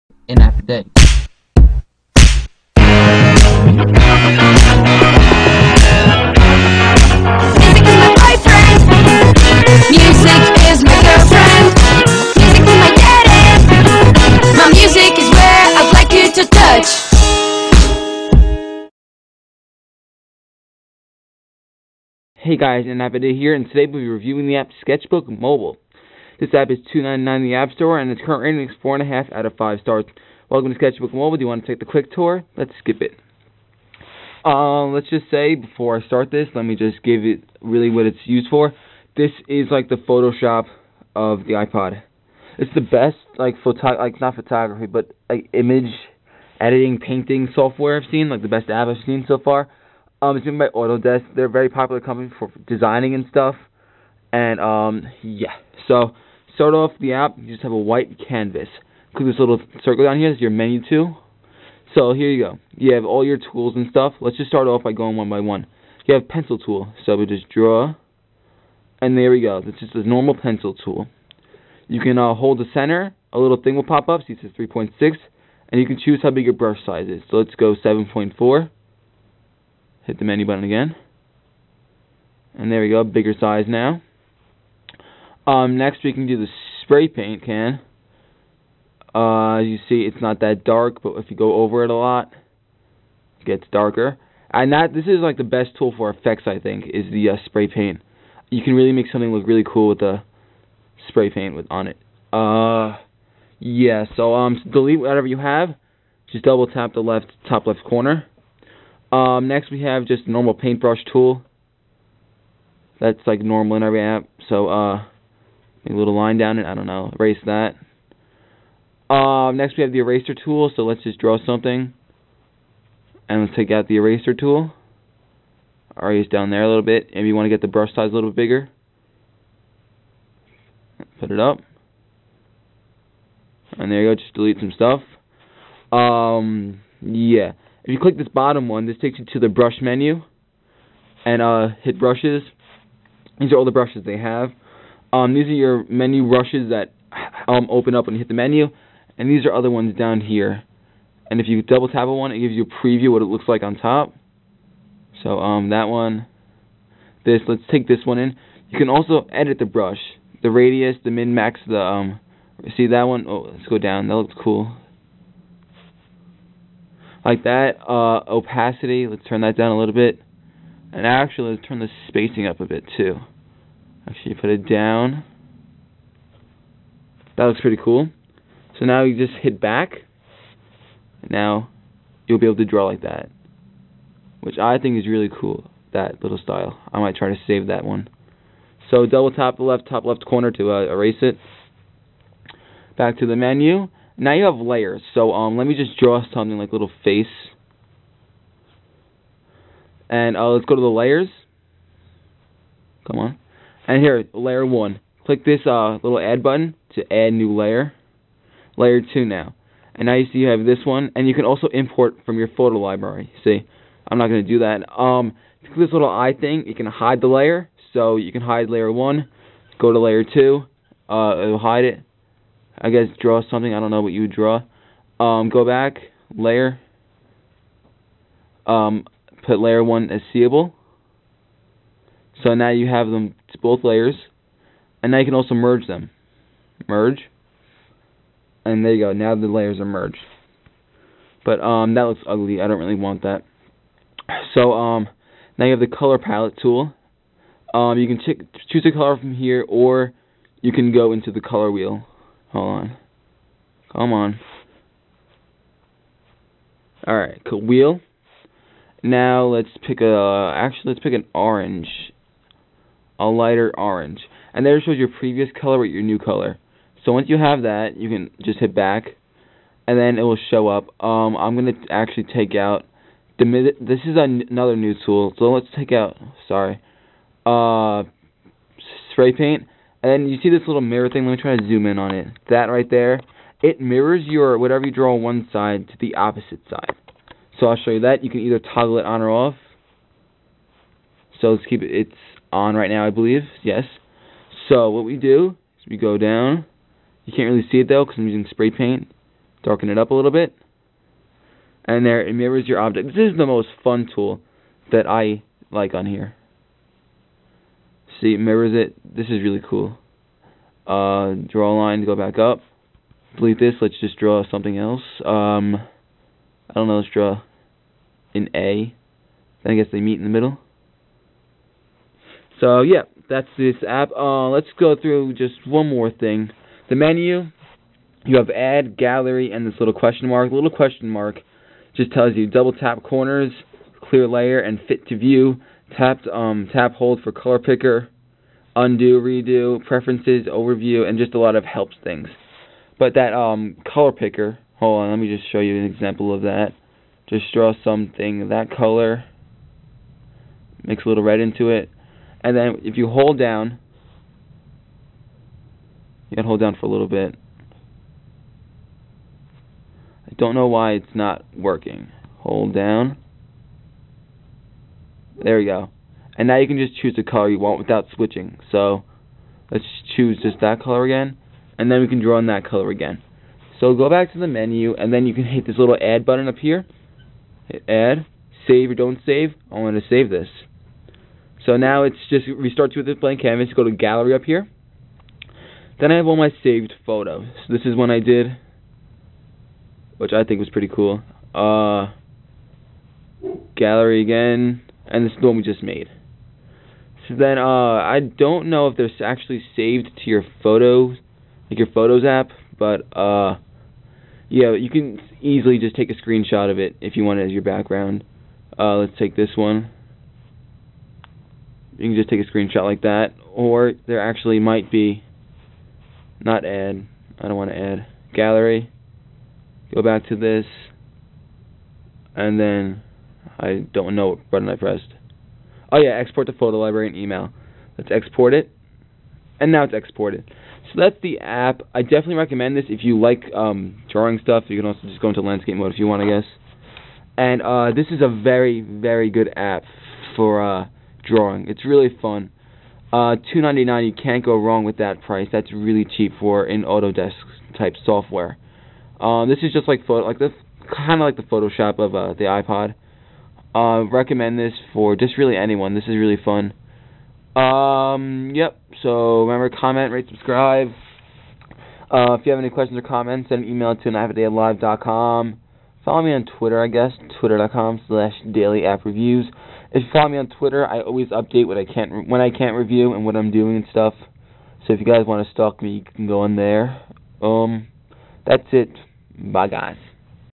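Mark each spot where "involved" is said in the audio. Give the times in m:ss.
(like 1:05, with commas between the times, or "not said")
not said.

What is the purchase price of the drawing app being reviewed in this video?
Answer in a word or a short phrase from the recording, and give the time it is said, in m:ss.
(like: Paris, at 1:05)
$2.99, at 0:26.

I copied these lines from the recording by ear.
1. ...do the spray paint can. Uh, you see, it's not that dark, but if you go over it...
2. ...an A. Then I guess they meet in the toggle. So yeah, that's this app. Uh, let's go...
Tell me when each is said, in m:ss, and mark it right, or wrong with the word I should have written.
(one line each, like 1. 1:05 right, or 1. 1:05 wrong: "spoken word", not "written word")
1. 1:26 right
2. 5:18 wrong: "middle", not "toggle".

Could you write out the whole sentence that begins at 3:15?
So um, let me just draw something like little face.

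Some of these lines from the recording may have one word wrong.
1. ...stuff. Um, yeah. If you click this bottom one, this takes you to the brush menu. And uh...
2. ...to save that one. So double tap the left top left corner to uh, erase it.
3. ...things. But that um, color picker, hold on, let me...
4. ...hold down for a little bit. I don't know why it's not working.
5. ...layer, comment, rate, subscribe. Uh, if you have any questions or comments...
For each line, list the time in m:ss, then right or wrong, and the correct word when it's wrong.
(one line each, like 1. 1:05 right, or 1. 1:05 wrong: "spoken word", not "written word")
1. 2:14 right
2. 3:07 right
3. 5:42 right
4. 5:56 right
5. 7:39 wrong: "remember", not "layer".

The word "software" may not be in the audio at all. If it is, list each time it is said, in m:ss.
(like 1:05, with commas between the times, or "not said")
0:47, 7:28.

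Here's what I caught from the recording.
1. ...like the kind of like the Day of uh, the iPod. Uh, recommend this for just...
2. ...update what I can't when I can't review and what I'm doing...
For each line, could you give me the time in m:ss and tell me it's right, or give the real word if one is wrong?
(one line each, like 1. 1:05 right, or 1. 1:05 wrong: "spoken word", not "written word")
1. 7:30 wrong: "Photoshop", not "Day"
2. 7:51 right.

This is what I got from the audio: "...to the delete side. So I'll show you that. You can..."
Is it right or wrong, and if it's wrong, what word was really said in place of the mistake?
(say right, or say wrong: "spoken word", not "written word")
wrong: "opposite", not "delete".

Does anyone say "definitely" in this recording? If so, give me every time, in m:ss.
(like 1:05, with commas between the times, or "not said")
7:12.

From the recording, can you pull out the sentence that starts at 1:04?
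Let's just start off by going one by one.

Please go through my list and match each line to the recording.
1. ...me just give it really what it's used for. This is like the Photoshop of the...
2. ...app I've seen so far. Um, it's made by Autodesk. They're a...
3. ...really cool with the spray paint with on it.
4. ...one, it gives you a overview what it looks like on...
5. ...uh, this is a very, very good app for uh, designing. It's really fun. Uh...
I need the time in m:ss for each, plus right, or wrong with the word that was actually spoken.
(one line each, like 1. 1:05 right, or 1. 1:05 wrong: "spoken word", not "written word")
1. 0:36 right
2. 0:48 right
3. 1:39 right
4. 2:32 wrong: "preview", not "overview"
5. 7:17 wrong: "drawing", not "designing".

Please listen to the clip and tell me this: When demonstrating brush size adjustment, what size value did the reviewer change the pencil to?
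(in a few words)
7.4.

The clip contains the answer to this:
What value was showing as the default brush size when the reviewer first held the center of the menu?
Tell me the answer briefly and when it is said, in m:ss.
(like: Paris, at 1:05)
3.6, at 1:14.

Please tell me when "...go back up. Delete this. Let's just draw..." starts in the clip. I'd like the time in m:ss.
5:12.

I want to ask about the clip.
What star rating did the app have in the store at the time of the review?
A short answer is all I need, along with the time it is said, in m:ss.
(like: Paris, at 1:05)
4.5 out of 5, at 0:28.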